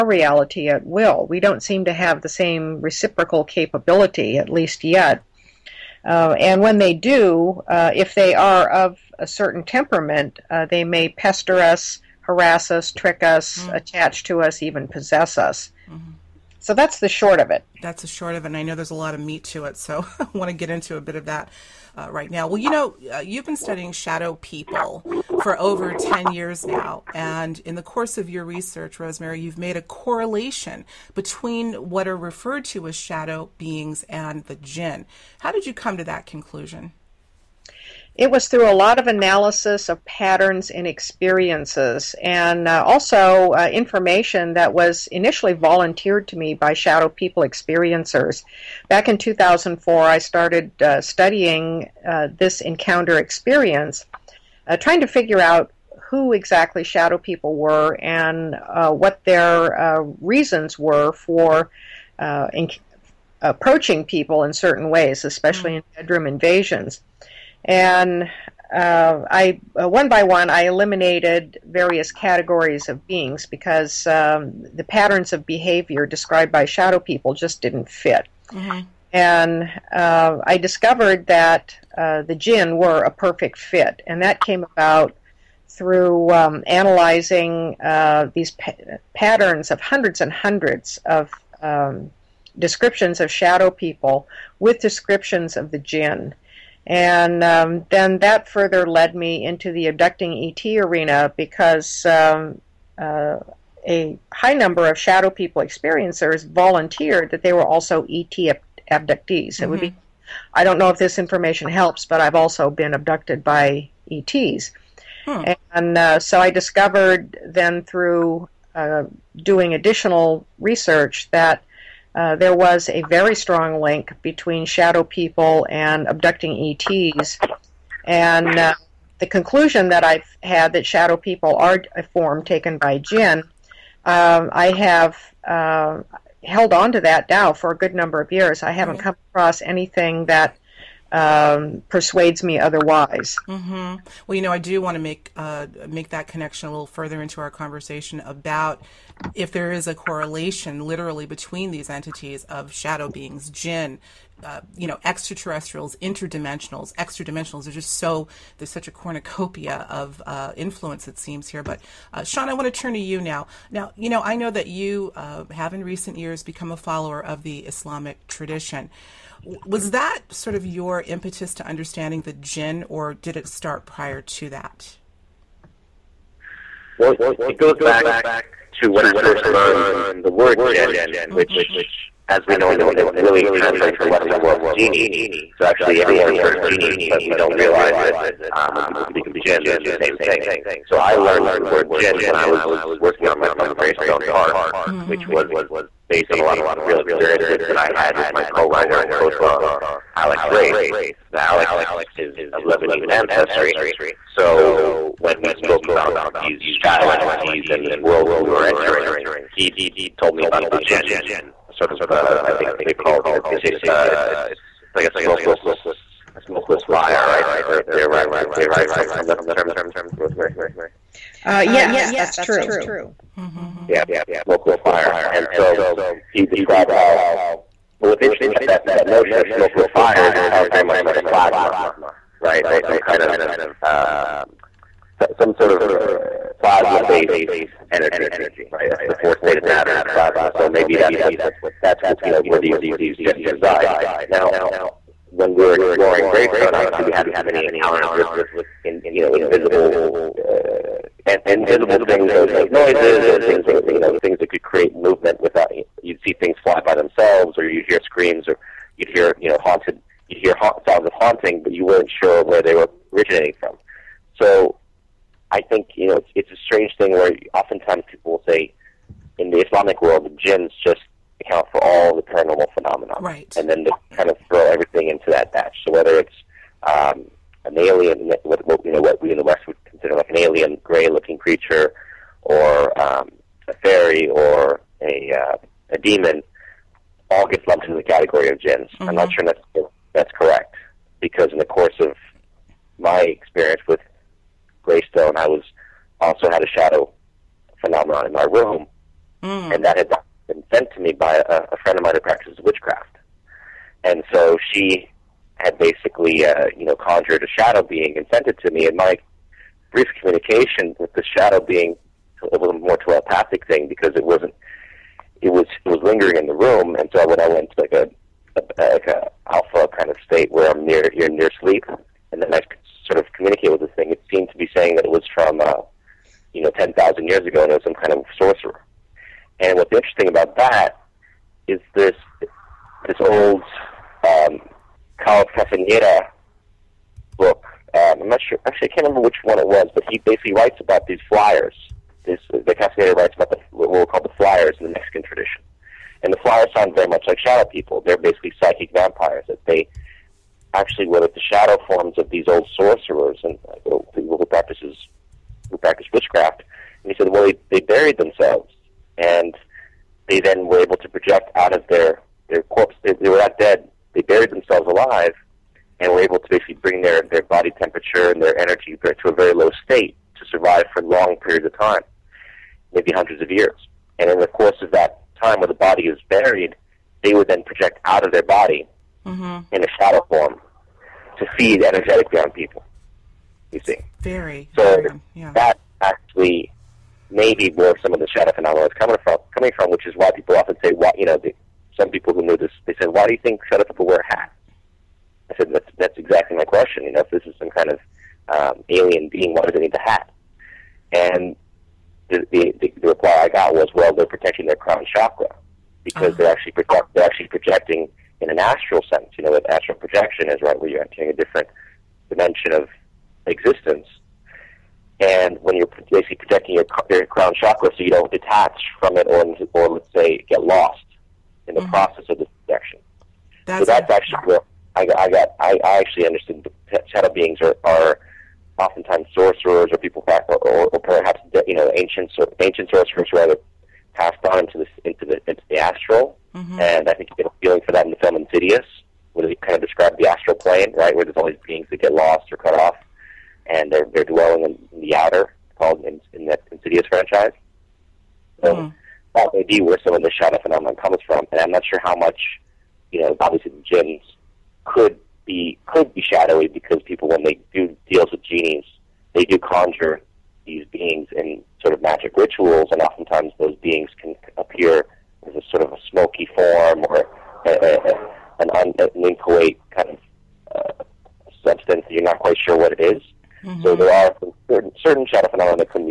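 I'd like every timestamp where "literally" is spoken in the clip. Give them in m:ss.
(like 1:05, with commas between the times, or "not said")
2:30.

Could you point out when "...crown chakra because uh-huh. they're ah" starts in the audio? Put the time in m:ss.
6:44.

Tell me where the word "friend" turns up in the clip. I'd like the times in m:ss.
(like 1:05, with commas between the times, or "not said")
5:01.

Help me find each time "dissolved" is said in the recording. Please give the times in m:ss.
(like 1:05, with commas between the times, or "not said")
not said.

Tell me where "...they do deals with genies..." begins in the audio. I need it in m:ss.
7:37.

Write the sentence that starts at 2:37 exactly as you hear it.
There's just so there's such a cornucopia of uh, influence it seems here.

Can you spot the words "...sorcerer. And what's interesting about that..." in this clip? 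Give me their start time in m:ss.
5:28.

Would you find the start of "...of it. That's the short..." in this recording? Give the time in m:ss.
0:17.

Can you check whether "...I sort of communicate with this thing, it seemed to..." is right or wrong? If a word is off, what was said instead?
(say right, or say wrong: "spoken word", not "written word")
right.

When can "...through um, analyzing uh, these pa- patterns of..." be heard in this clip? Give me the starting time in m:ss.
1:25.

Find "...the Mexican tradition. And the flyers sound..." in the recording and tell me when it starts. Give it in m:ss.
5:44.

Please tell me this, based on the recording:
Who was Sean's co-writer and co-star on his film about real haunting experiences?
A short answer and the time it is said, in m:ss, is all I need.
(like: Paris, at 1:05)
Alex Wraith, at 3:20.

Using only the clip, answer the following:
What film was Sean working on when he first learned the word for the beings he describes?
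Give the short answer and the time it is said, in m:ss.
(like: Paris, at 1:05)
Greystone Park, at 3:13.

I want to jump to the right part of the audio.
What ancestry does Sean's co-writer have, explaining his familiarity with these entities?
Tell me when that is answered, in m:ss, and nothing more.
3:22.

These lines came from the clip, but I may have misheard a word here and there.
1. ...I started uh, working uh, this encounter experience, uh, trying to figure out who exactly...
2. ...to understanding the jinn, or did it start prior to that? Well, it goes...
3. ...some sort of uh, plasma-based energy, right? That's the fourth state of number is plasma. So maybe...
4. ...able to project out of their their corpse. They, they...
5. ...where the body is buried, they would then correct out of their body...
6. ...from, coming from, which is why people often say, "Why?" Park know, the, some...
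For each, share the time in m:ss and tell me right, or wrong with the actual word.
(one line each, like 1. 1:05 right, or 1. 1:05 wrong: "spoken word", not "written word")
1. 0:50 wrong: "studying", not "working"
2. 2:51 right
3. 3:55 wrong: "matter", not "number"
4. 6:00 right
5. 6:15 wrong: "project", not "correct"
6. 6:29 wrong: "You", not "Park".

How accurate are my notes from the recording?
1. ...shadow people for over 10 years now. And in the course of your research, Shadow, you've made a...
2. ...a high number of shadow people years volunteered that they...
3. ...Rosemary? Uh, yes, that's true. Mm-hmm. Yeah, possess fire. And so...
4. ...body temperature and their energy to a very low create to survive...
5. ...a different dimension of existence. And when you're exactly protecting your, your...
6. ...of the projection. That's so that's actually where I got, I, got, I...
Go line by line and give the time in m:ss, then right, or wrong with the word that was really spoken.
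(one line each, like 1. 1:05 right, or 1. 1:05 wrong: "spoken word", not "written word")
1. 0:23 wrong: "Rosemary", not "Shadow"
2. 1:43 wrong: "experiencers", not "years"
3. 3:40 wrong: "smokeless", not "possess"
4. 6:07 wrong: "state", not "create"
5. 6:51 wrong: "basically", not "exactly"
6. 7:02 right.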